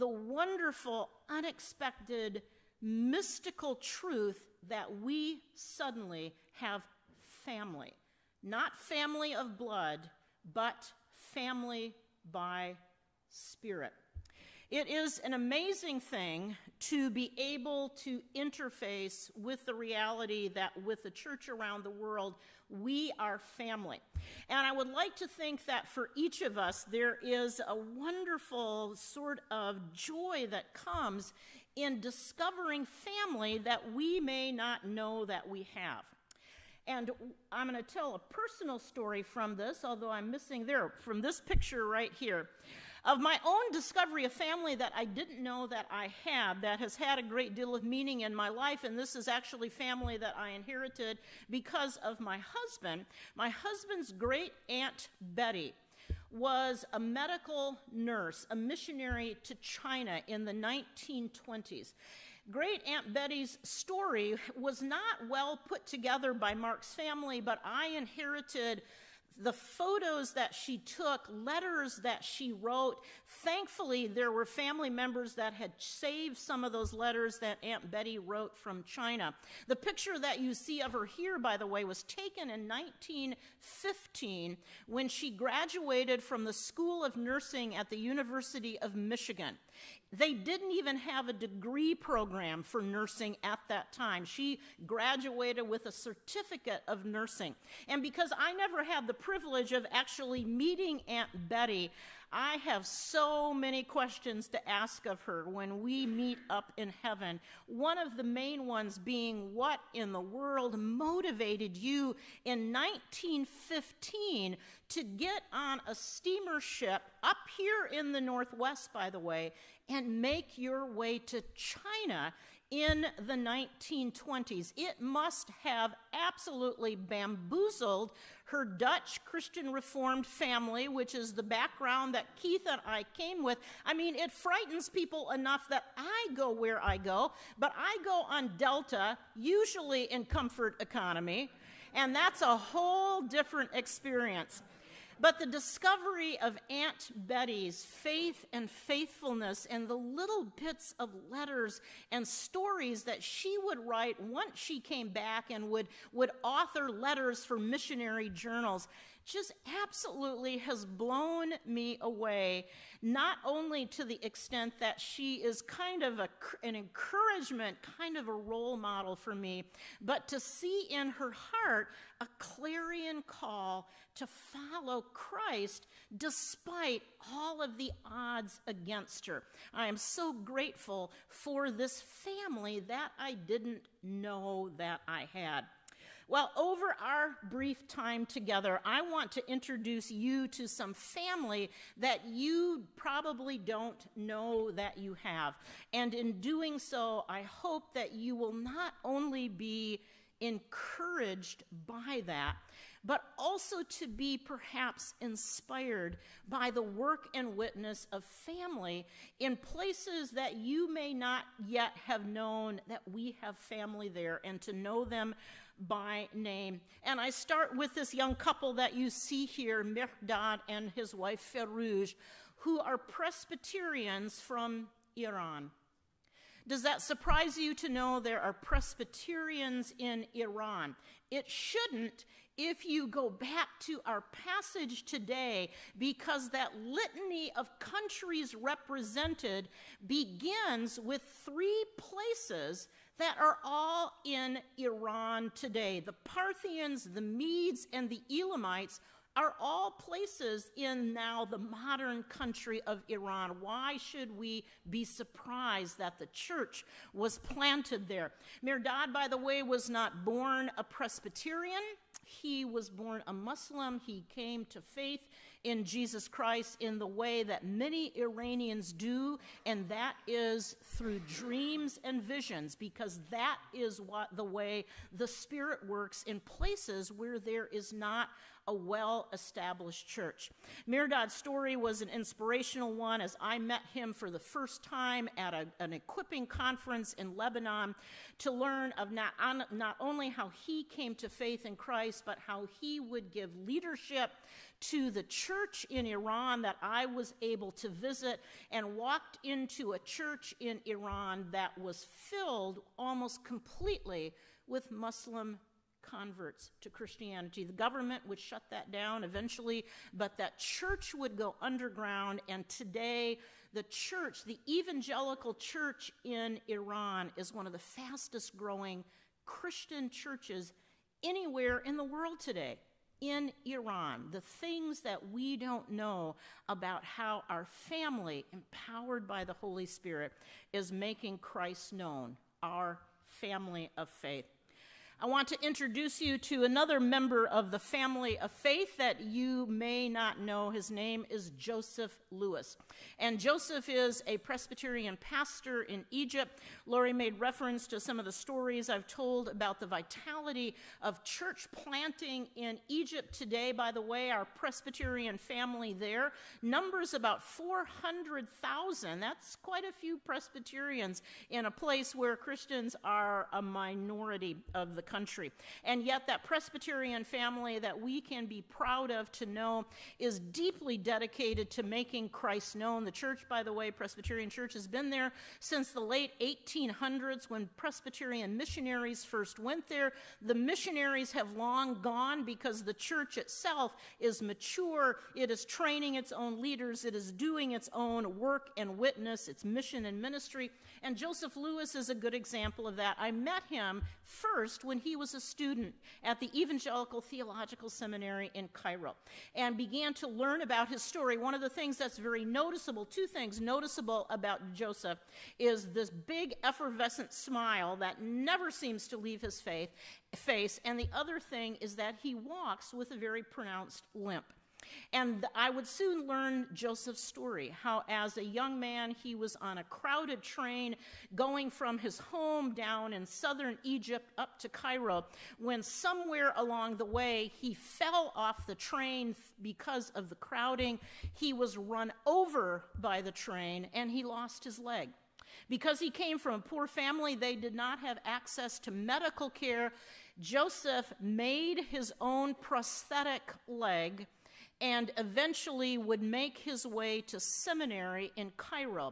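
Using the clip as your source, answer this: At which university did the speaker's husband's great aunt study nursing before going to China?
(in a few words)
University of Michigan.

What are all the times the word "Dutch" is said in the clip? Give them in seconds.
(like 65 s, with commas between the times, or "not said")
128 s.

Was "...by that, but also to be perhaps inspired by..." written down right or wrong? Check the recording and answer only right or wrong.
right.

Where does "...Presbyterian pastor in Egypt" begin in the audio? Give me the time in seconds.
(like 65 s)
344 s.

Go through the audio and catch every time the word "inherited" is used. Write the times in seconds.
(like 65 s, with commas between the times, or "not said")
50 s, 67 s.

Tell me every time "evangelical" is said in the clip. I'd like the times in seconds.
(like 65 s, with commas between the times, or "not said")
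314 s, 396 s.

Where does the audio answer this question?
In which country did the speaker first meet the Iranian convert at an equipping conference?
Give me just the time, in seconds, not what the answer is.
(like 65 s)
287 s.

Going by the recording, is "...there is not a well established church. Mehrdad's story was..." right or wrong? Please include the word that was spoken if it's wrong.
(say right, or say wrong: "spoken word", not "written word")
right.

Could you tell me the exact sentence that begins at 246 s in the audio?
The Parthians, the Medes, and the Elamites are all places in now the modern country of Iran.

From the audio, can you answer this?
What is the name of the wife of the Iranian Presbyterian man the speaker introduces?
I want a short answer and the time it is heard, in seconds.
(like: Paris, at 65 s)
Ferouj, at 221 s.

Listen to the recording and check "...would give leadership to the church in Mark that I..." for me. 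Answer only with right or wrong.
wrong.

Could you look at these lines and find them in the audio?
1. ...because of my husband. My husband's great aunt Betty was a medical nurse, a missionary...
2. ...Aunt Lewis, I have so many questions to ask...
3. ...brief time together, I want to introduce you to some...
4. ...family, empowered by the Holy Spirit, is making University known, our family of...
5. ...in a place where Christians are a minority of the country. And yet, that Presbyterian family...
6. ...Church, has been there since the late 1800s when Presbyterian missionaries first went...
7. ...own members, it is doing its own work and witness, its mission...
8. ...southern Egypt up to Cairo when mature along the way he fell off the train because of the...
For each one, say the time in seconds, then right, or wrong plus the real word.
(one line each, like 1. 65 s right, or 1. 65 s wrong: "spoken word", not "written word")
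1. 51 s right
2. 101 s wrong: "Betty", not "Lewis"
3. 187 s right
4. 327 s wrong: "Christ", not "University"
5. 361 s right
6. 374 s right
7. 386 s wrong: "leaders", not "members"
8. 423 s wrong: "somewhere", not "mature".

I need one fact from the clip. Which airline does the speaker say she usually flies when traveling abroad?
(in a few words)
Delta.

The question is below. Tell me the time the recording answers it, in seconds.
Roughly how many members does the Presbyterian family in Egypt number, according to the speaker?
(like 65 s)
357 s.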